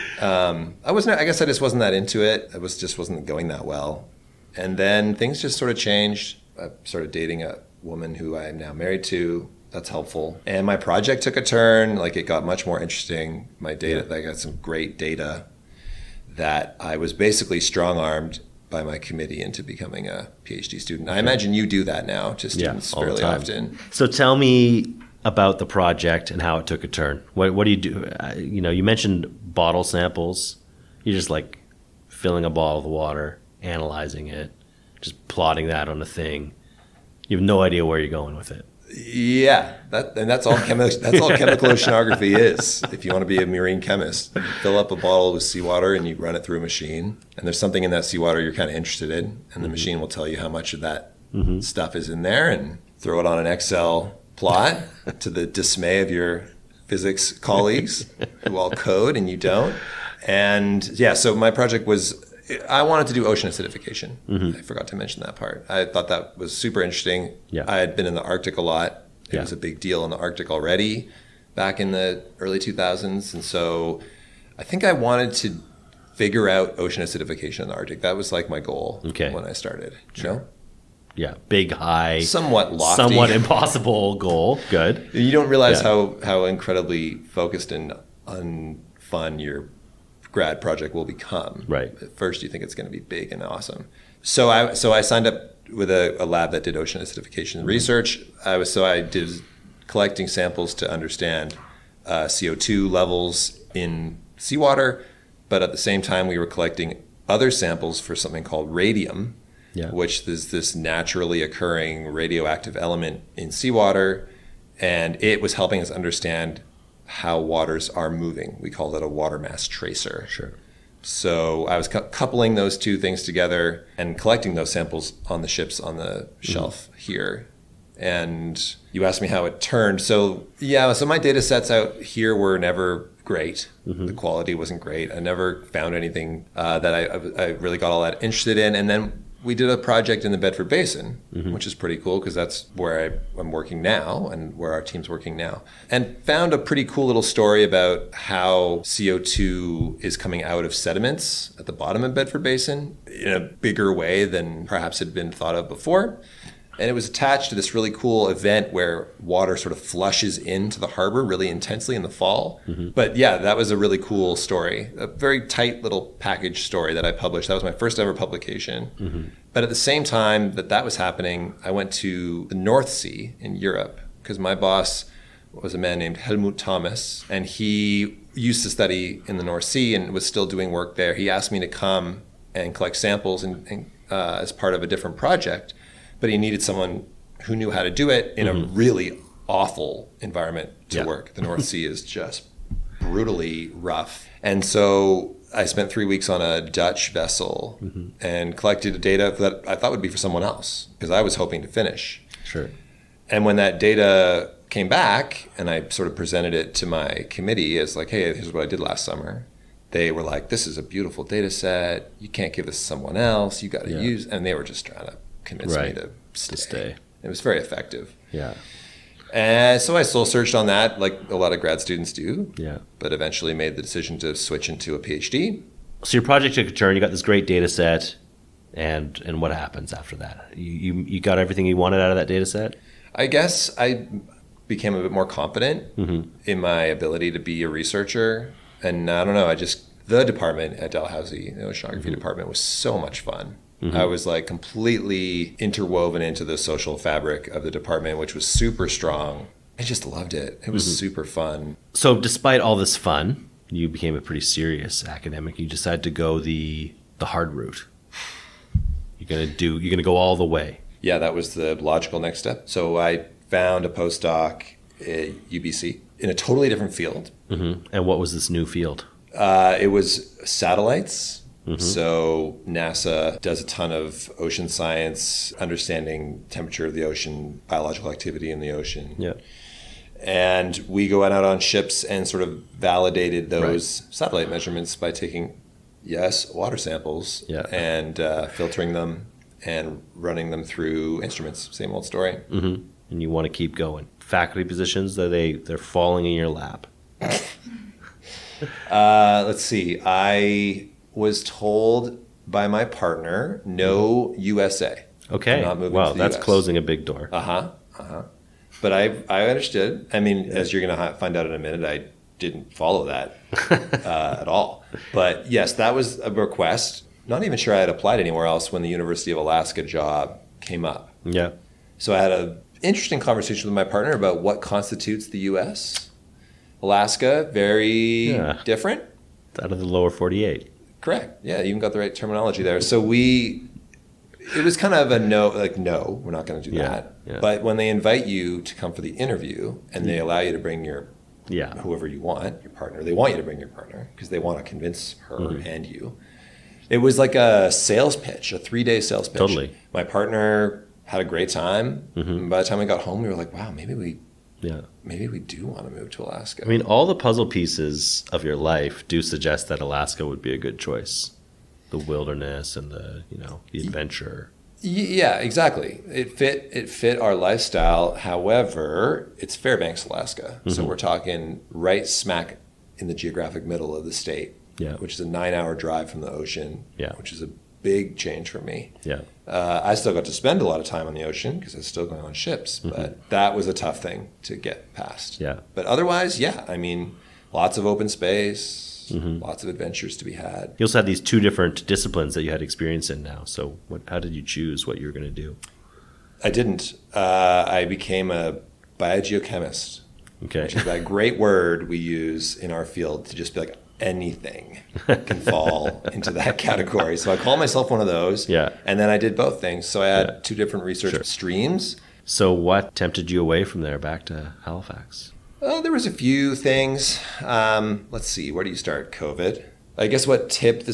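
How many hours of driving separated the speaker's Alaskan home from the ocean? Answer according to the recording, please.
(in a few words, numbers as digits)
9.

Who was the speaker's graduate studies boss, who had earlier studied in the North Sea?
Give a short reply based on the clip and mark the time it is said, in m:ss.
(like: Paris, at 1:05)
Helmut Thomas, at 2:56.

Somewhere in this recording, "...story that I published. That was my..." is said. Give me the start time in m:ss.
2:46.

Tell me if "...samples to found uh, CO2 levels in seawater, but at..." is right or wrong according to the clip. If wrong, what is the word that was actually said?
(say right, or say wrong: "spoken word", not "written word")
wrong: "understand", not "found".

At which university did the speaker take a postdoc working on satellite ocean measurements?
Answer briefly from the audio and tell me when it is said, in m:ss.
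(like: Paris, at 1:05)
UBC, at 4:25.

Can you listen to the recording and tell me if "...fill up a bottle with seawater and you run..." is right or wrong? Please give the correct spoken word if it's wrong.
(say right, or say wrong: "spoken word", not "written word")
right.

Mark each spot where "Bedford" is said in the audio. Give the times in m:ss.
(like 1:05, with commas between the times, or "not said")
2:20, 2:32.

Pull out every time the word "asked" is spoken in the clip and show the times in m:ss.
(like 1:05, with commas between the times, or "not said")
2:09, 3:01.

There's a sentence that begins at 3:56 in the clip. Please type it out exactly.
in my ability to be a researcher, and I don't know.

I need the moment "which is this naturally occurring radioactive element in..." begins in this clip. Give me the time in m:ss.
1:49.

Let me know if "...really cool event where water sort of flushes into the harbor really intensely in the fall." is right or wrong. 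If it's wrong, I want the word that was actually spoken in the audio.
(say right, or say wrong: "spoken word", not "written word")
right.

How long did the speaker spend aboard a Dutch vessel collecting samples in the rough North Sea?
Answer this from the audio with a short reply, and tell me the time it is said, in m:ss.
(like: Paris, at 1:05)
3 weeks, at 3:15.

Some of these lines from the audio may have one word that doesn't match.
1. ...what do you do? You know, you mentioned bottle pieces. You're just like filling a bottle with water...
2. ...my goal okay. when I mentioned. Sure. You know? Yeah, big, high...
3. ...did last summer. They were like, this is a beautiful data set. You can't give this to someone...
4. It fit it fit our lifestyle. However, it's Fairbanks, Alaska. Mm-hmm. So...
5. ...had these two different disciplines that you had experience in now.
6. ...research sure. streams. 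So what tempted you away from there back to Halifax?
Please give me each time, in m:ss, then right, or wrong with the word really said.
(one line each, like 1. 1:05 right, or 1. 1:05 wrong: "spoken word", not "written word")
1. 0:27 wrong: "samples", not "pieces"
2. 1:18 wrong: "started", not "mentioned"
3. 3:28 right
4. 6:06 right
5. 6:30 right
6. 6:50 right.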